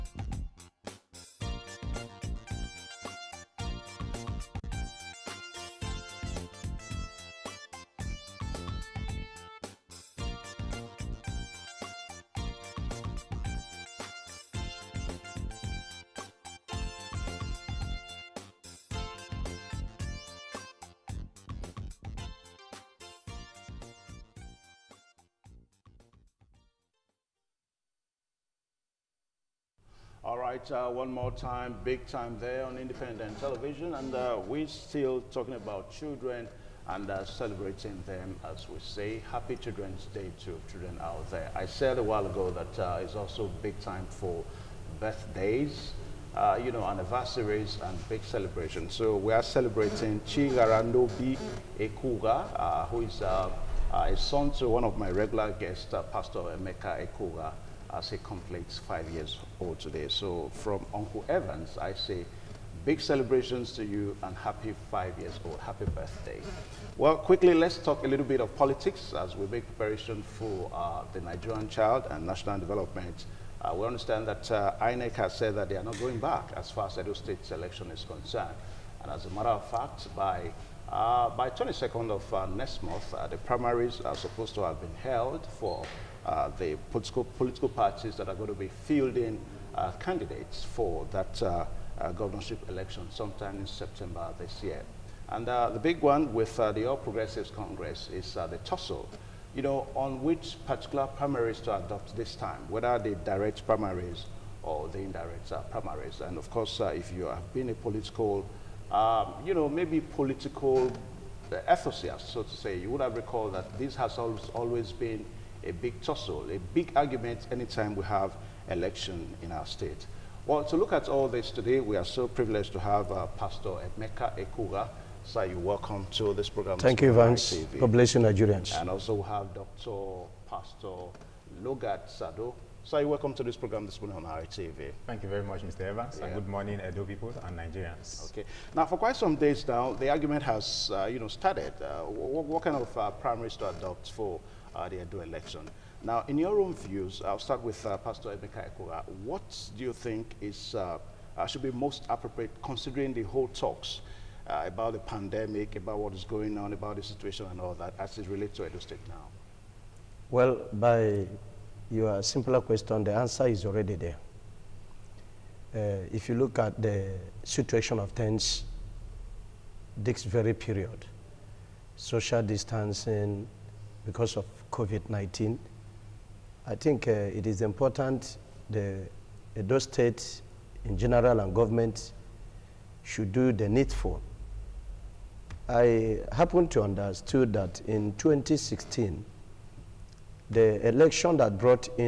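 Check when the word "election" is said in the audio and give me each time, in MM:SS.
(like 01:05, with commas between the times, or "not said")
01:17, 01:32, 01:58, 02:25, 03:10.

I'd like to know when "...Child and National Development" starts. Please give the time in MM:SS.
01:11.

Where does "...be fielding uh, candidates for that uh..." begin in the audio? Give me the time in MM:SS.
01:28.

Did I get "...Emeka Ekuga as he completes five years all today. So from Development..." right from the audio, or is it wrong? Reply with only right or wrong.
wrong.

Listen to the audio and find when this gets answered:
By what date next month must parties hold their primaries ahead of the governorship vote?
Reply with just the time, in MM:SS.
01:21.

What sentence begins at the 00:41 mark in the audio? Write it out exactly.
I said a while ago that uh, it's also big time for birthdays, uh, you know, anniversaries and big celebrations.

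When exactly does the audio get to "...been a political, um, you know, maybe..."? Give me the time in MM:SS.
01:47.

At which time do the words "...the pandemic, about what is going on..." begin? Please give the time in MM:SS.
02:34.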